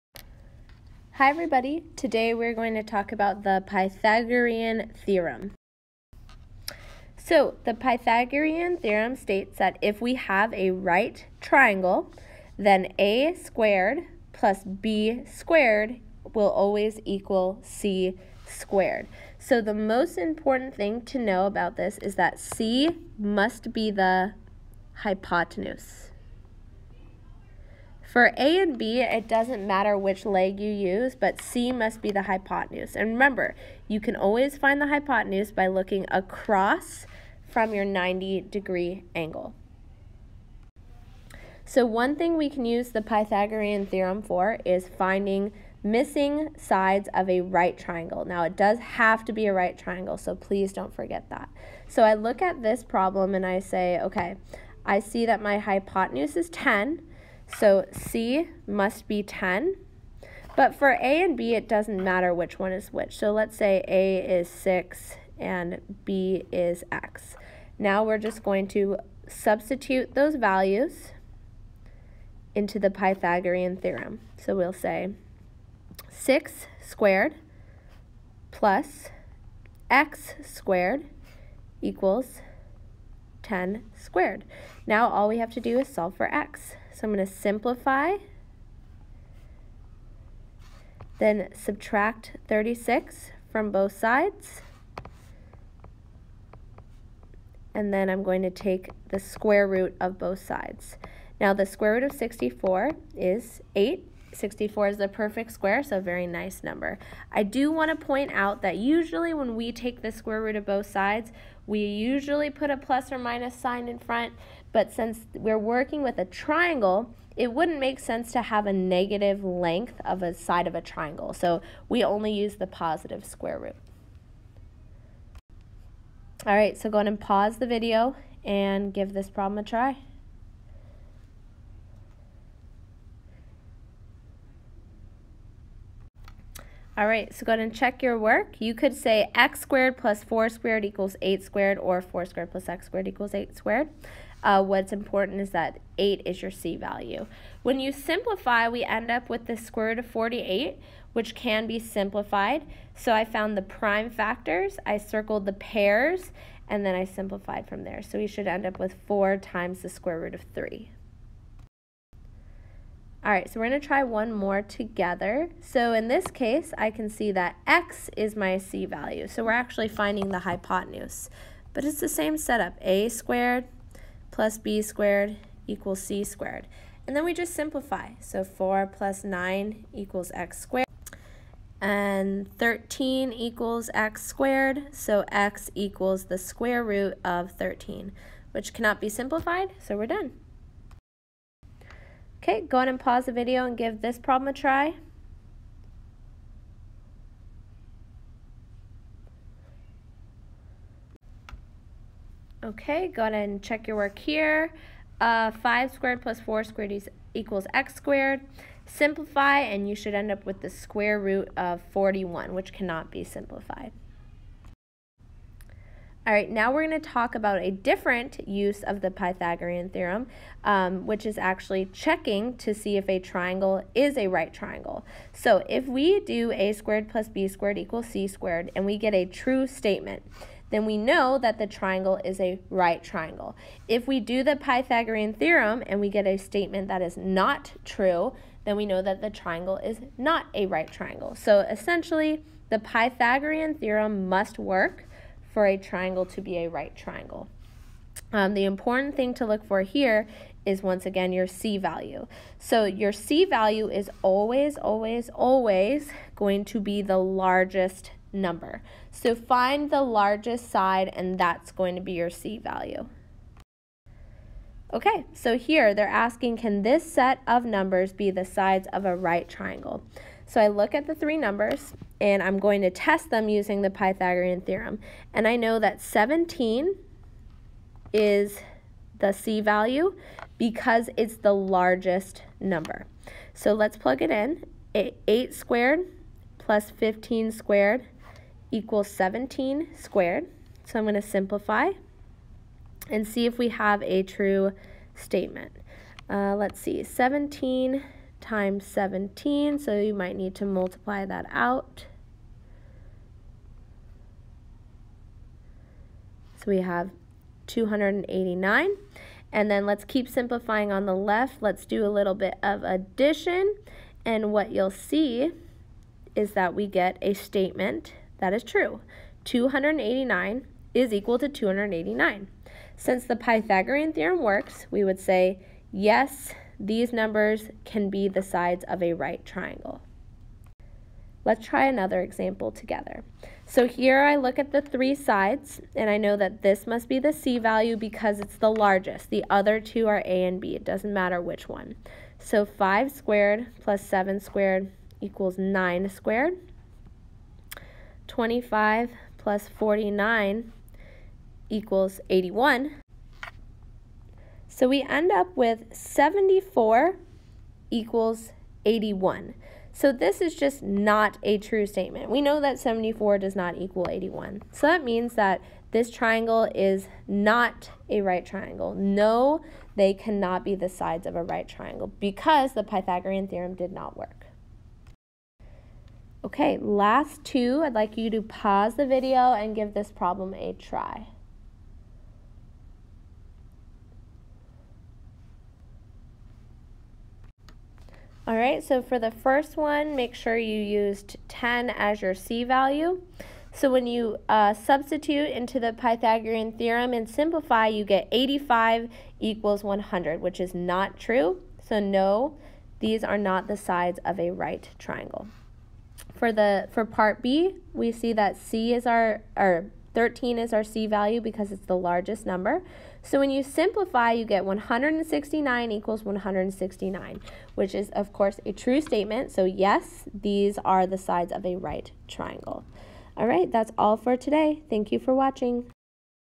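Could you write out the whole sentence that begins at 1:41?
Now the square root of 64 is 8, 64 is the perfect square, so very nice number.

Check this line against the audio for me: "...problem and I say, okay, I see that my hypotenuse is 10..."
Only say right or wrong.
right.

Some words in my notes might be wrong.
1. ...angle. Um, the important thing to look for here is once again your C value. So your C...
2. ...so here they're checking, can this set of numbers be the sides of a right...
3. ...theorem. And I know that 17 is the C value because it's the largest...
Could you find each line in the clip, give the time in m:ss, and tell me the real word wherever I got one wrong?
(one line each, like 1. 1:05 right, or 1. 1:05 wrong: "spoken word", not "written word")
1. 4:06 wrong: "triangle", not "angle"
2. 4:25 wrong: "asking", not "checking"
3. 4:34 right.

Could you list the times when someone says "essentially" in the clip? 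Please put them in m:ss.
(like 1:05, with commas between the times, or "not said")
4:01.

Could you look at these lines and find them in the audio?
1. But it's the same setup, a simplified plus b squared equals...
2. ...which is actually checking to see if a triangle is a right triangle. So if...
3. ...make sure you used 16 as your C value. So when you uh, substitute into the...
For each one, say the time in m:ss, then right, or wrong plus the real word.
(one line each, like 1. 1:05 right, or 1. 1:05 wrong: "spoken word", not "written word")
1. 2:51 wrong: "squared", not "simplified"
2. 3:41 right
3. 6:30 wrong: "10", not "16".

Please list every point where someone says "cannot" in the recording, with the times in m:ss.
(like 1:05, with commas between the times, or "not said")
3:08, 3:32, 6:10.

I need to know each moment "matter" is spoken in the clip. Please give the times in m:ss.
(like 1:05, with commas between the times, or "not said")
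0:29, 1:02, 5:41.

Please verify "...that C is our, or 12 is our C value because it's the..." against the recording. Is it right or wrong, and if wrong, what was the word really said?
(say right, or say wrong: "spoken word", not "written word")
wrong: "13", not "12".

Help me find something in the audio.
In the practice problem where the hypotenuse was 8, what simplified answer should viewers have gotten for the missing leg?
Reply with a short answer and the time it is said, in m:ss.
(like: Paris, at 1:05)
4 times the square root of 3, at 2:39.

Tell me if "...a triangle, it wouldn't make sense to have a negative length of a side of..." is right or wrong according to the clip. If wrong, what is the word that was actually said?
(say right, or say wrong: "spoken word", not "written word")
right.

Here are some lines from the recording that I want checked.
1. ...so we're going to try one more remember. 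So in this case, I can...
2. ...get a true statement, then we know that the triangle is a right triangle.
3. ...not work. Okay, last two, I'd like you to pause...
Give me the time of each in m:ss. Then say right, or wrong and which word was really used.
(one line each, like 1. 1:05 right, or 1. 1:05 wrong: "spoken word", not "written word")
1. 2:43 wrong: "together", not "remember"
2. 3:48 right
3. 6:13 right.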